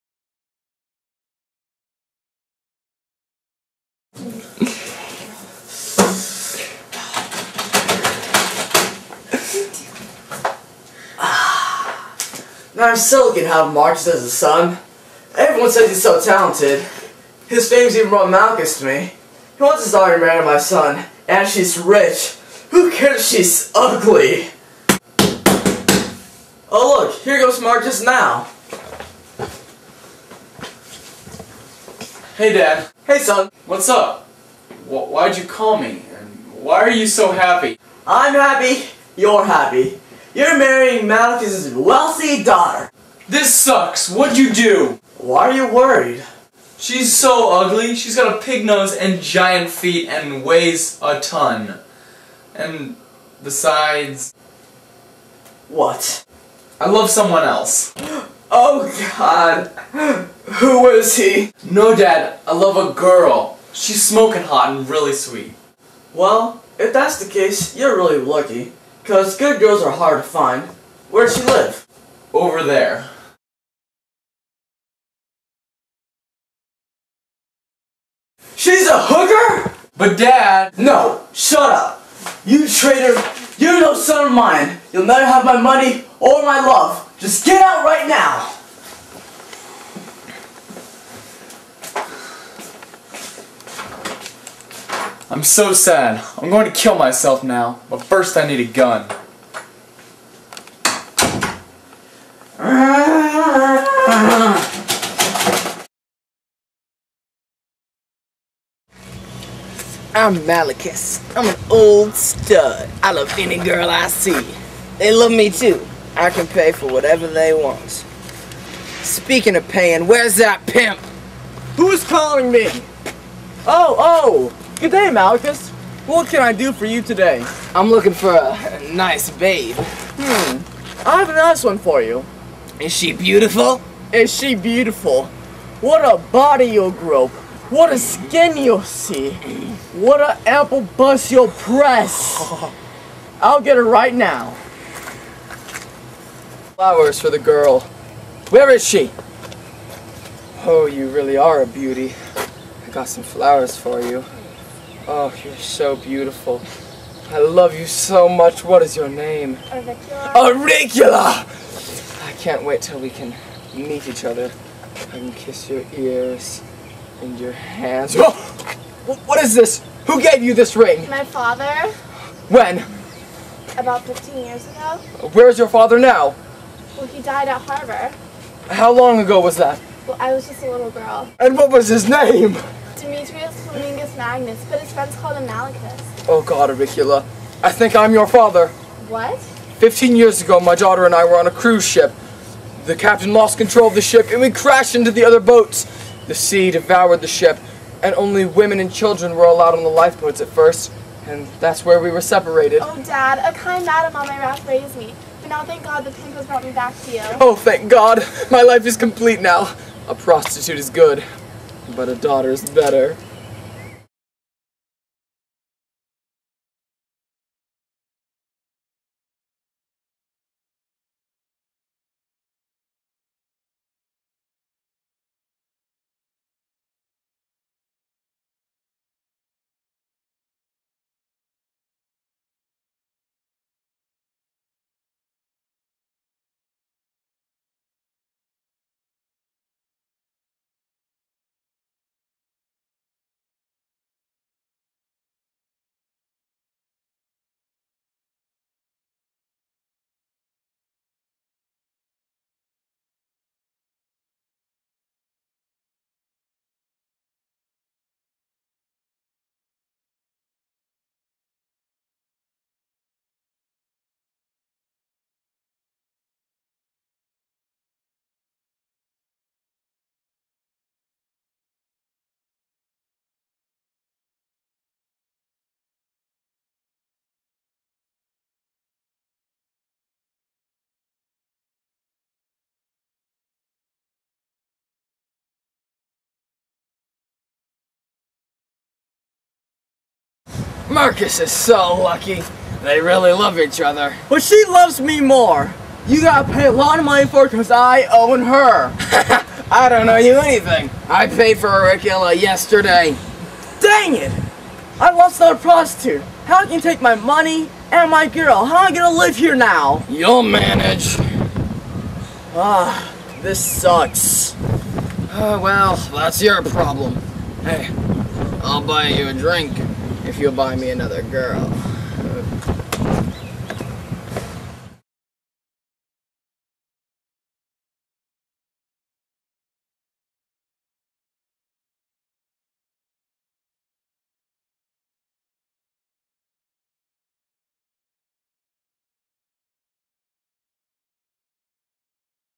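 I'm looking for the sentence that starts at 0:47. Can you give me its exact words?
She's got a pig nose and giant feet and weighs a ton.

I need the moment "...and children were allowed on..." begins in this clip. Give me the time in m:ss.
3:18.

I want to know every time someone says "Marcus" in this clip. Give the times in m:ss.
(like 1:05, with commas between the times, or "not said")
0:13, 0:27, 4:50.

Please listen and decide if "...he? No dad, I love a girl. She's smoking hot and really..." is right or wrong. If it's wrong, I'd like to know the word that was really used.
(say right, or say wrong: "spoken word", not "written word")
right.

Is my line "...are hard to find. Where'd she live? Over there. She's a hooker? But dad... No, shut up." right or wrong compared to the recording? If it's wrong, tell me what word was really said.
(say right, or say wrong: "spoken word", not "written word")
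right.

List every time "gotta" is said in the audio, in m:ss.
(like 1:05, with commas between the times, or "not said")
4:56.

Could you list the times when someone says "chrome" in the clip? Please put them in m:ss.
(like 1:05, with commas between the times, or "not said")
not said.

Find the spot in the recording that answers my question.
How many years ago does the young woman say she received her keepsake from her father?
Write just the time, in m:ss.
2:54.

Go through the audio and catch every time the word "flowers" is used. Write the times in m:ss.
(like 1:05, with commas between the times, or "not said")
2:26, 2:33.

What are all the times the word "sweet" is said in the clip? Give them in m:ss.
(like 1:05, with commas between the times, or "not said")
1:05.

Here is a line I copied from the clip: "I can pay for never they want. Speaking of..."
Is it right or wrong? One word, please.
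wrong.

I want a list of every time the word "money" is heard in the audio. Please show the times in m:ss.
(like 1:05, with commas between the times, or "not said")
1:25, 4:57, 5:07.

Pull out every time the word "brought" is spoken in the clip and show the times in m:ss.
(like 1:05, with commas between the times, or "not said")
0:18, 3:26.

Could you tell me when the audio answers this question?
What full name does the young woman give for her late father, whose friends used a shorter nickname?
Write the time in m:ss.
3:02.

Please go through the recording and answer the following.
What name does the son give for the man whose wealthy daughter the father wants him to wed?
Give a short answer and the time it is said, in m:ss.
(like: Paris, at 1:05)
Malachi, at 0:41.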